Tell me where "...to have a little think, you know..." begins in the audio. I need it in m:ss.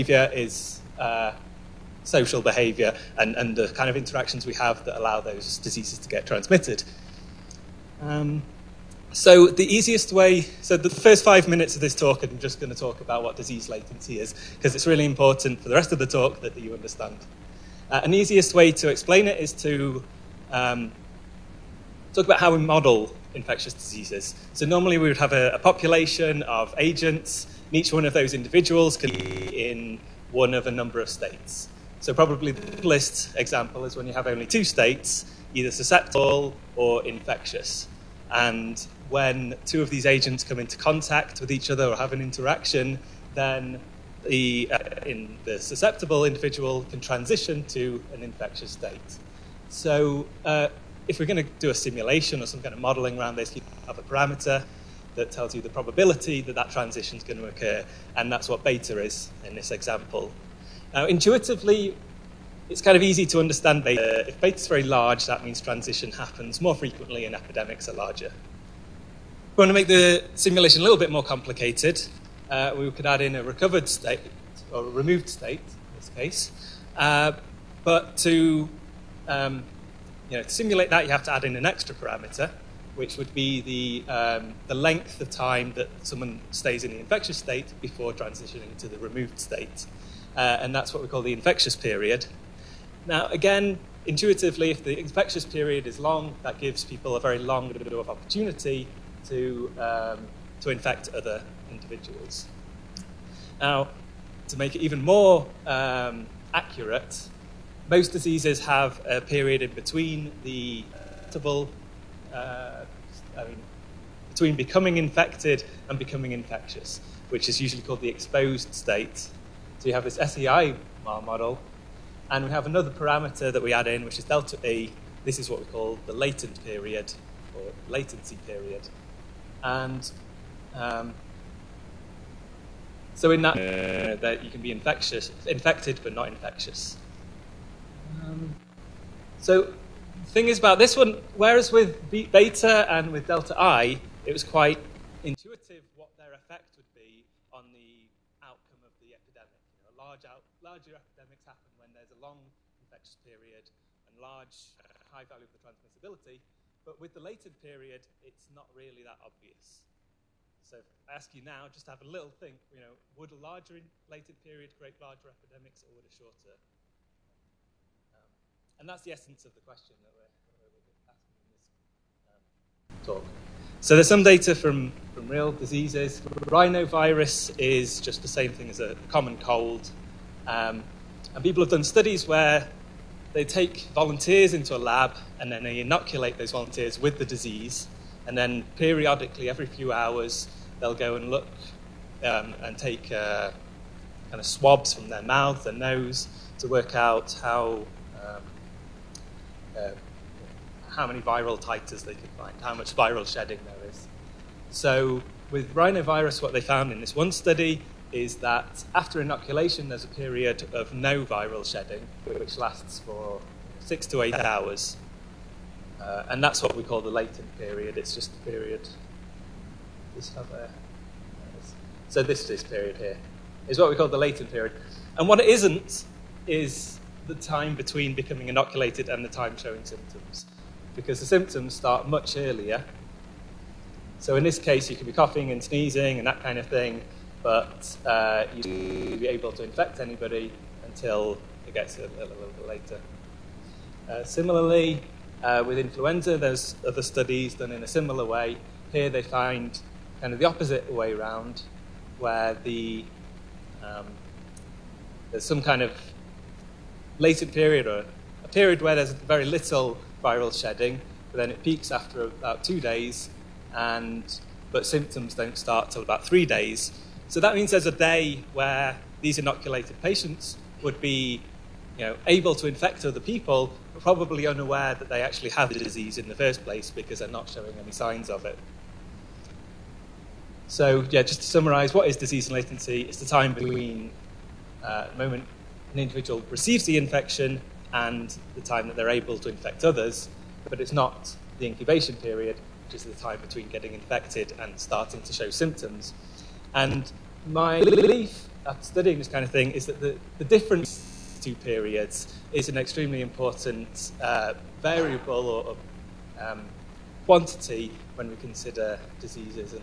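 2:41.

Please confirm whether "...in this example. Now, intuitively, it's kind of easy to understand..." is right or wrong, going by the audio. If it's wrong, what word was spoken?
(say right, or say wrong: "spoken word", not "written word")
right.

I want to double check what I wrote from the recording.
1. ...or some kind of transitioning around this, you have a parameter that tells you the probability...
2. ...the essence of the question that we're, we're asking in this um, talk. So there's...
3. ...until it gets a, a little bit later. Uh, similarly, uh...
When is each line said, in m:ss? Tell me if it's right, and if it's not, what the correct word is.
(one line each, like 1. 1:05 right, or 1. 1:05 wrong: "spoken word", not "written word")
1. 0:52 wrong: "modeling", not "transitioning"
2. 2:49 right
3. 4:00 right.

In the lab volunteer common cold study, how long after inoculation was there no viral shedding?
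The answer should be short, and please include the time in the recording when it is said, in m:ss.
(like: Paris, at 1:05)
6 to 8 hours, at 3:33.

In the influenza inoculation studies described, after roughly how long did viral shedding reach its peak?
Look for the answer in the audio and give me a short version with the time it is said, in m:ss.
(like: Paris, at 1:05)
2 days, at 4:22.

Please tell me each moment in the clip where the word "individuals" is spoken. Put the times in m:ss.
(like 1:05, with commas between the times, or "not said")
0:28, 0:46, 1:41, 4:45.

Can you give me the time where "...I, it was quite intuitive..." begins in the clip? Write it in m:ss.
2:23.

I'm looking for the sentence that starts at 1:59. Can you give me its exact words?
So you have this SEI model, and we have another parameter that we add in, which is delta E.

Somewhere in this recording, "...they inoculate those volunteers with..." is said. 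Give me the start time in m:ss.
3:05.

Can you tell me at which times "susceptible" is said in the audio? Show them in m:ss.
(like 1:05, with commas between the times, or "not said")
0:35, 0:45.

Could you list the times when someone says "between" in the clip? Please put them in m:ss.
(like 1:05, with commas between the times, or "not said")
1:49, 1:54, 3:47, 4:43, 4:53.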